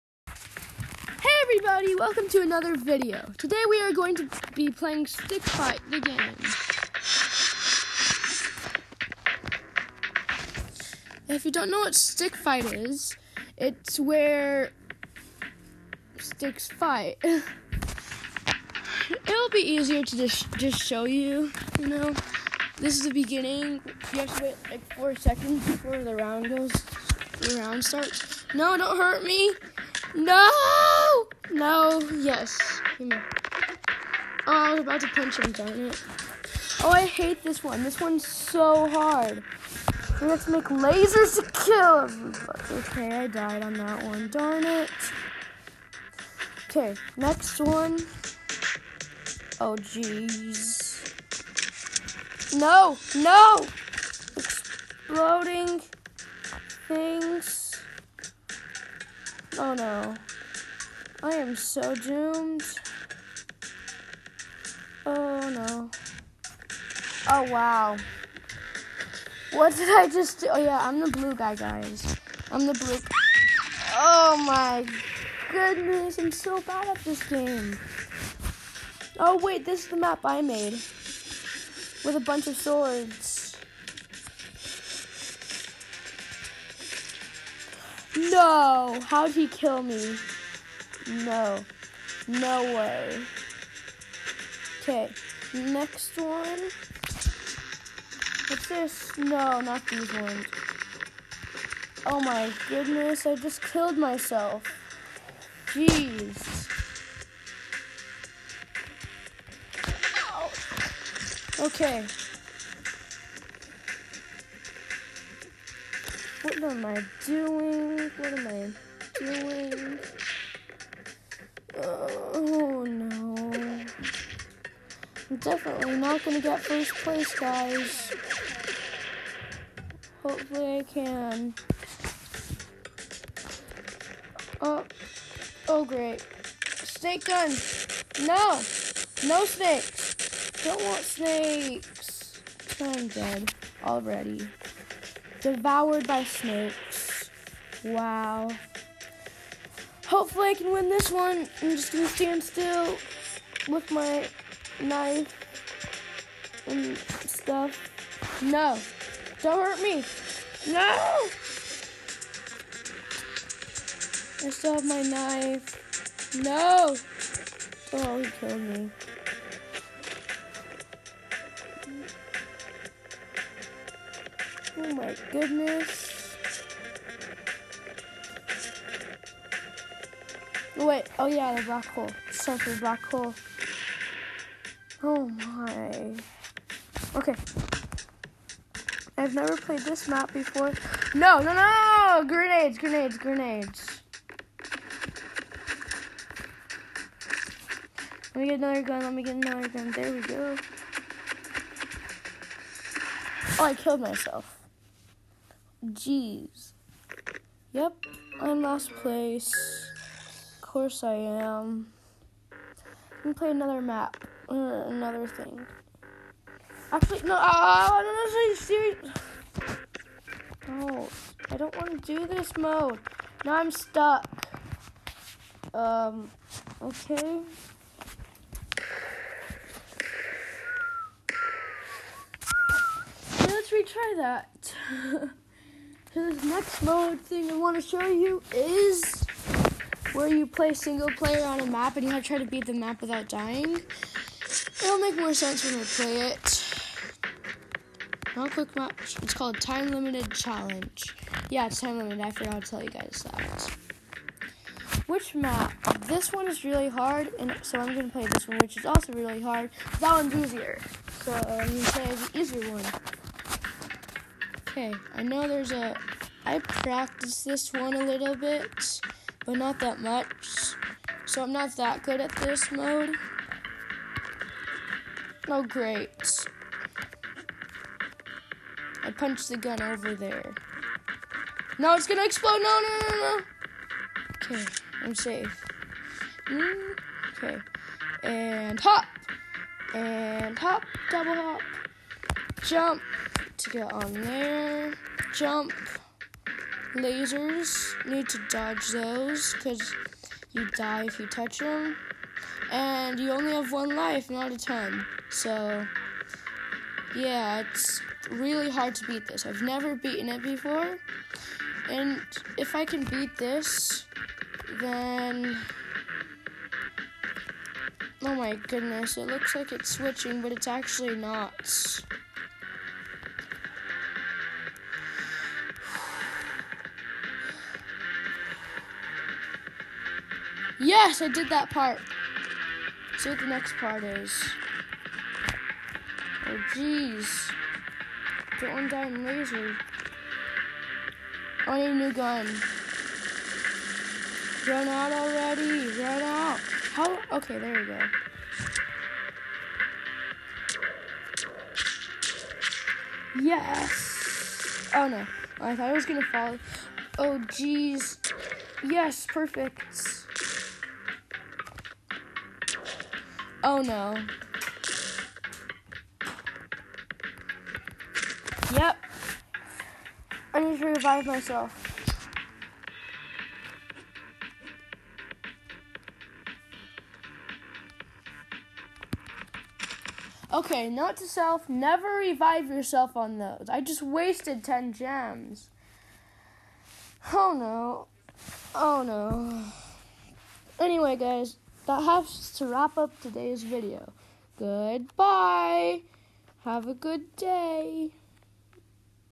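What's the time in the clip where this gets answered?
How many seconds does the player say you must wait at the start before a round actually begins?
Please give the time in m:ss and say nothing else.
0:24.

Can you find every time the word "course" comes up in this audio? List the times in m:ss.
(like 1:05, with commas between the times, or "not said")
3:30.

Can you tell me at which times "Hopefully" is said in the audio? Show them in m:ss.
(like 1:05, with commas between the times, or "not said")
2:10, 2:30.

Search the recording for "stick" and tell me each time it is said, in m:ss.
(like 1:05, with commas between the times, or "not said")
0:05, 0:11, 0:16.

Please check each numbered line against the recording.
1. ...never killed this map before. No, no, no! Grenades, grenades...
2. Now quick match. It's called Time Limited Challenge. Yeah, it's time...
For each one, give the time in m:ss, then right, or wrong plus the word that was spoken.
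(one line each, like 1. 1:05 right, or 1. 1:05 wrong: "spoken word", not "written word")
1. 3:09 wrong: "played", not "killed"
2. 4:08 right.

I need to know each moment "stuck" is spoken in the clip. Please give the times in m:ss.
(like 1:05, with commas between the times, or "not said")
3:43.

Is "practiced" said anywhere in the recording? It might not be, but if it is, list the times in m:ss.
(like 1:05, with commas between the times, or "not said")
4:26.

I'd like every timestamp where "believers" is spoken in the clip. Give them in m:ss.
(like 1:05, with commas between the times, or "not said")
not said.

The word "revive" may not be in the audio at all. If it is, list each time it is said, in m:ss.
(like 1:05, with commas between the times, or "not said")
6:10, 6:22.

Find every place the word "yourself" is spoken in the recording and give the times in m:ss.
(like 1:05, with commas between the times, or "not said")
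6:22.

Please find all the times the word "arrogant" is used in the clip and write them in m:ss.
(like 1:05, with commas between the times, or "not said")
not said.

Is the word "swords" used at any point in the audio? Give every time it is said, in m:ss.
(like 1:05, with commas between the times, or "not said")
1:22.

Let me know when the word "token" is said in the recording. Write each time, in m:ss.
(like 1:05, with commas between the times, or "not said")
not said.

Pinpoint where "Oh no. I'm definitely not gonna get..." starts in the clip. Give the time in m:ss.
2:01.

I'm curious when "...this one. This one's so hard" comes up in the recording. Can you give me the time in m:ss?
0:37.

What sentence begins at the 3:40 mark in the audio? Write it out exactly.
No, I don't want to do this mode.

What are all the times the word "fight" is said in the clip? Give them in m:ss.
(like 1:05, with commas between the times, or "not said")
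0:05, 0:12, 0:16.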